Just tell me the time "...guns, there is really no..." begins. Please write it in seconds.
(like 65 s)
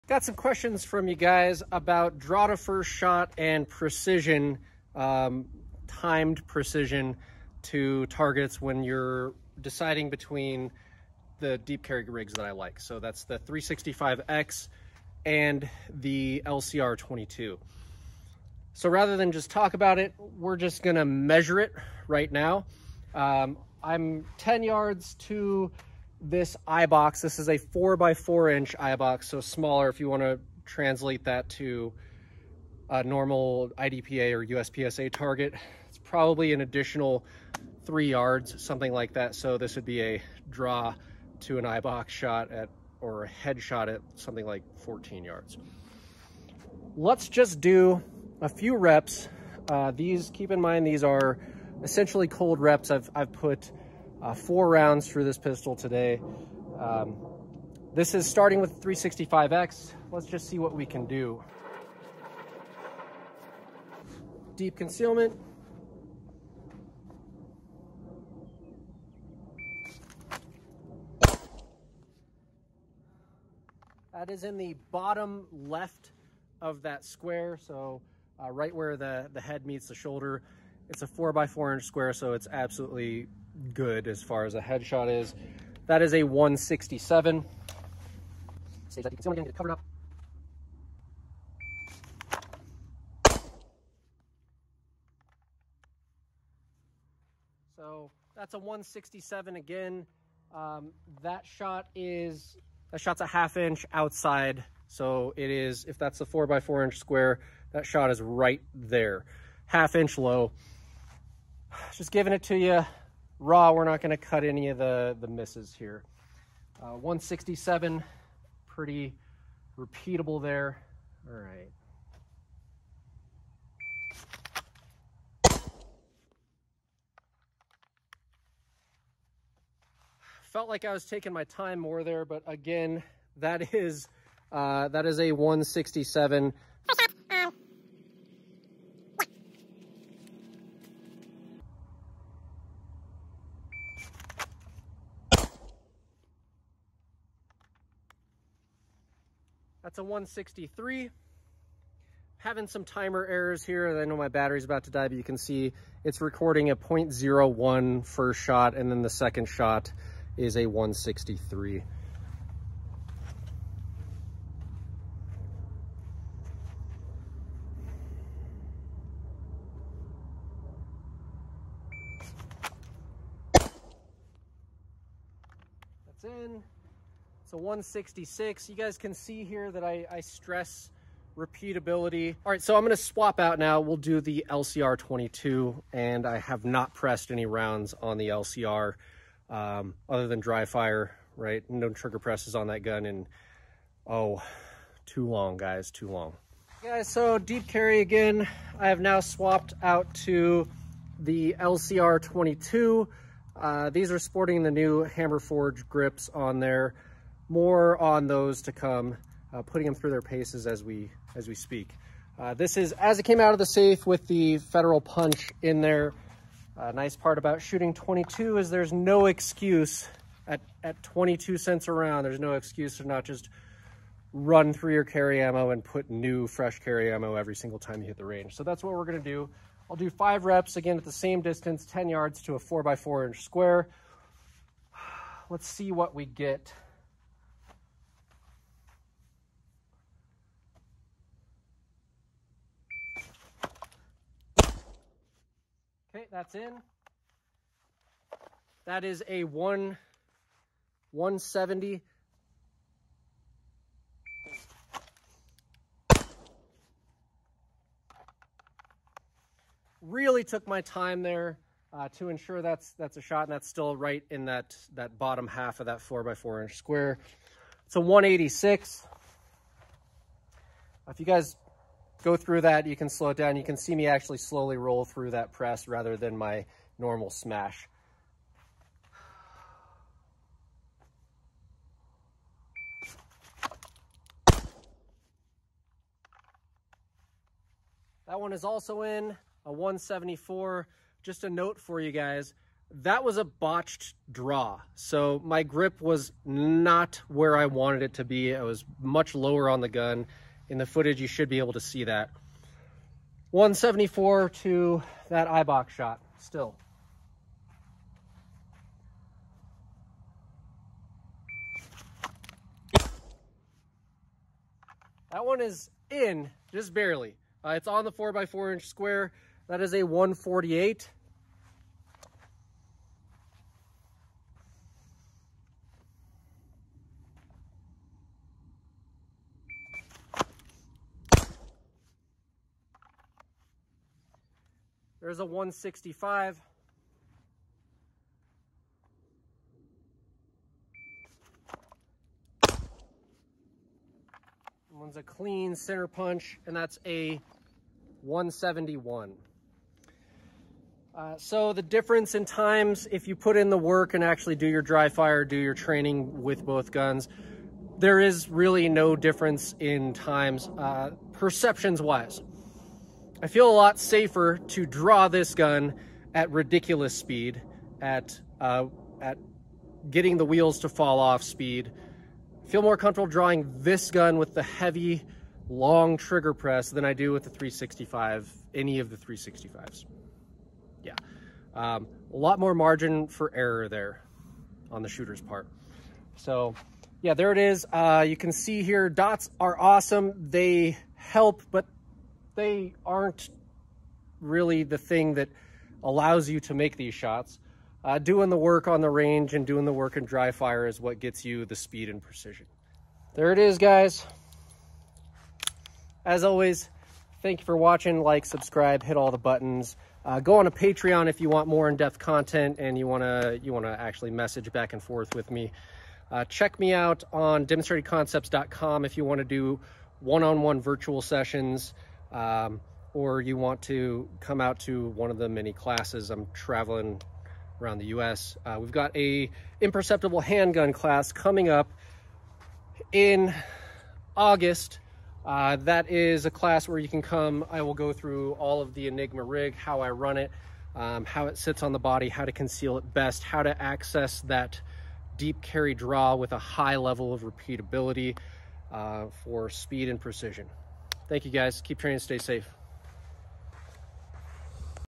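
356 s.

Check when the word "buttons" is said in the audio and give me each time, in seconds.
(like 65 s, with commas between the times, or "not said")
409 s.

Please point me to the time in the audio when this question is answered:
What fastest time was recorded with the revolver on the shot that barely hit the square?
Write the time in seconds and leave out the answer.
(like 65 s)
320 s.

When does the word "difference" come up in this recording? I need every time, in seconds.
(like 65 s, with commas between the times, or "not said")
351 s, 359 s.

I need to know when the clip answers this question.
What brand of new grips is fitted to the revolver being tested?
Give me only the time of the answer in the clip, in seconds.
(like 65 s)
205 s.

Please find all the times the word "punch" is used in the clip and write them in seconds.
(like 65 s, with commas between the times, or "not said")
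215 s, 346 s.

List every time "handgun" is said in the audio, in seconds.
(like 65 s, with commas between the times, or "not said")
430 s.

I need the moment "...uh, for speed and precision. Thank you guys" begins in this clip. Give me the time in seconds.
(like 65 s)
448 s.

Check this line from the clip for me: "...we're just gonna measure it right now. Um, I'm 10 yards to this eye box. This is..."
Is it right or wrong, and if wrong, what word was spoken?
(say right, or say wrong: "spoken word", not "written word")
right.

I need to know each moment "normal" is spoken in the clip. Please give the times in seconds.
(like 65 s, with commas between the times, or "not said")
33 s, 276 s.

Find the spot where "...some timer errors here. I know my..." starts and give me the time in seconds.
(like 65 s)
152 s.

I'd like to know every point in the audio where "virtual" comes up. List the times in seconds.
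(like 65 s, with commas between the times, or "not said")
420 s.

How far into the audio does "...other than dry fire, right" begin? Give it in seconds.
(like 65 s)
190 s.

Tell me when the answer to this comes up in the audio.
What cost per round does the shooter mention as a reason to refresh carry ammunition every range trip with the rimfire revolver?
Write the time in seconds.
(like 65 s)
221 s.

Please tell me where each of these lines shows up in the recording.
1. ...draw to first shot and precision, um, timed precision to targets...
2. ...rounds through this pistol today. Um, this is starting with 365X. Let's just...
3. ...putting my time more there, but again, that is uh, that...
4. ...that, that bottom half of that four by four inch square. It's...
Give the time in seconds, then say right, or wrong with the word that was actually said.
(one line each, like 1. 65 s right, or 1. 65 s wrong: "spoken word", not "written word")
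1. 2 s right
2. 54 s right
3. 131 s wrong: "taking", not "putting"
4. 264 s right.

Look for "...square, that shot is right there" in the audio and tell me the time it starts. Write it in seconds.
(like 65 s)
106 s.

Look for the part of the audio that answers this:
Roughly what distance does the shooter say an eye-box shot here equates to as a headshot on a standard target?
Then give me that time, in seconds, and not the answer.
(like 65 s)
44 s.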